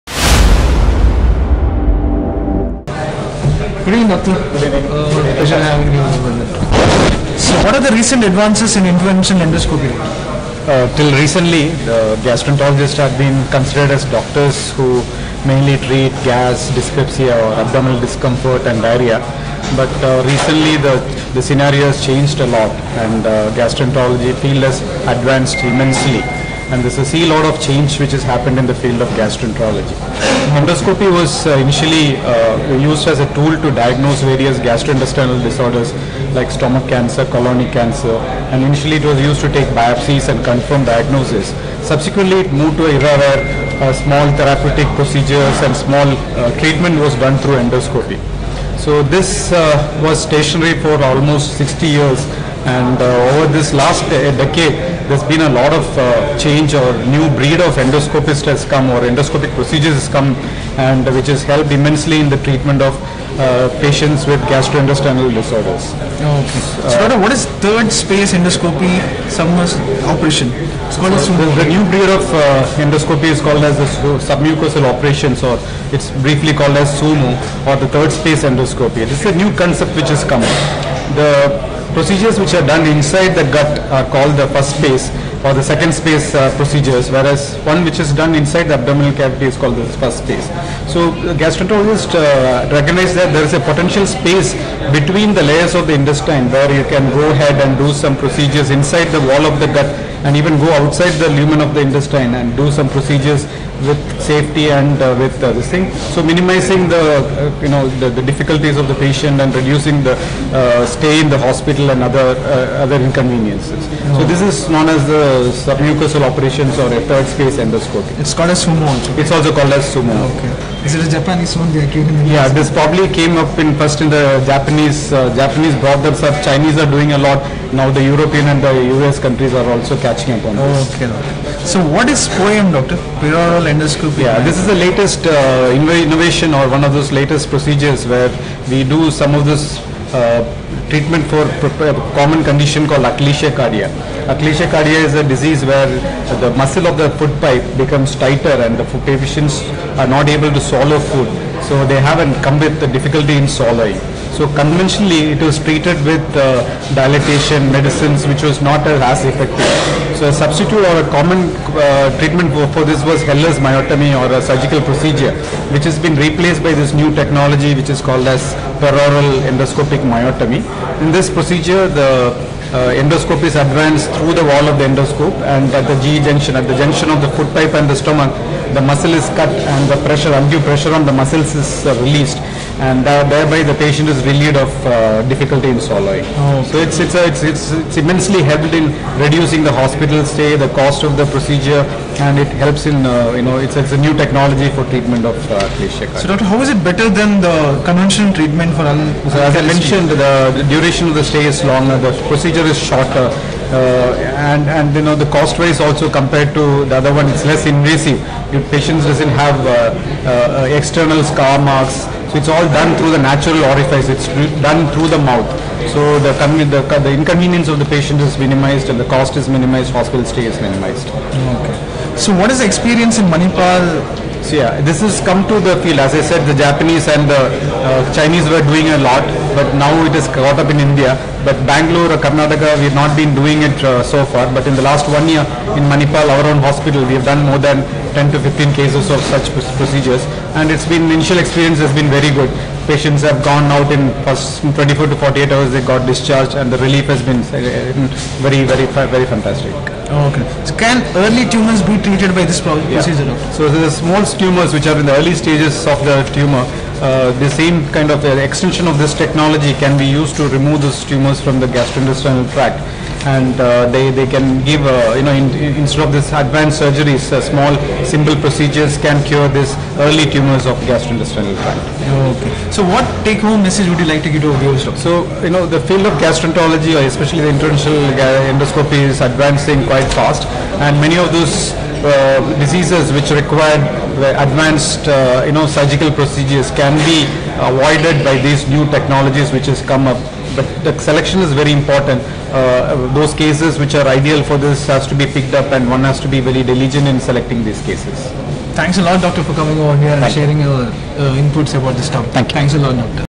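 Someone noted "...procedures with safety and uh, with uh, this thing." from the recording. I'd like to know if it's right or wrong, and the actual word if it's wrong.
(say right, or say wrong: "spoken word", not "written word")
right.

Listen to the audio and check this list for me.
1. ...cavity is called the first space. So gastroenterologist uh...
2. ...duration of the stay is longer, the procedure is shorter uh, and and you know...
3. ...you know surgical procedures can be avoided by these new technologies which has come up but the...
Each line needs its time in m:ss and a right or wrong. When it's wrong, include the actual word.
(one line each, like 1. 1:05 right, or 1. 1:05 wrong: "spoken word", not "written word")
1. 1:29 right
2. 3:20 right
3. 4:45 right.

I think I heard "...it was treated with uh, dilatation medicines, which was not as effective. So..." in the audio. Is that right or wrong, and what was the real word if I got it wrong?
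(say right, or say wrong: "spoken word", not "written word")
right.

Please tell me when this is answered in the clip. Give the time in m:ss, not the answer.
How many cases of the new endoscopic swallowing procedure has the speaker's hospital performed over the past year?
3:58.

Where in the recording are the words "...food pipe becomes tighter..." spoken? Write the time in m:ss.
2:27.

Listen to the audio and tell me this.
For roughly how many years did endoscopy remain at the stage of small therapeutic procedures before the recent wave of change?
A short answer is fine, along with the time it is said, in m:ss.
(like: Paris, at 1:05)
60 years, at 0:51.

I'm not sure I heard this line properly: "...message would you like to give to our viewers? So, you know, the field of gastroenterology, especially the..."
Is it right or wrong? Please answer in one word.
right.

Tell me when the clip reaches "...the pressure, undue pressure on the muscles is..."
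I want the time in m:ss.
2:59.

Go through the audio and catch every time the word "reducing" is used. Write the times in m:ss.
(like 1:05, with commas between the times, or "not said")
1:49, 3:09.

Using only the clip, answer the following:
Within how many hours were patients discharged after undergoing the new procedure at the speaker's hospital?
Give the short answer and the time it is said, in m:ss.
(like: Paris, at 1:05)
24 to 48 hours, at 4:04.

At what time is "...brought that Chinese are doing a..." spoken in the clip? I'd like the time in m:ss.
2:05.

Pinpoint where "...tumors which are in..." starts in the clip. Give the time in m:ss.
4:14.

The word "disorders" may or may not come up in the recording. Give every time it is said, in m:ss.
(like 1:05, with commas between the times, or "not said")
0:35, 1:05.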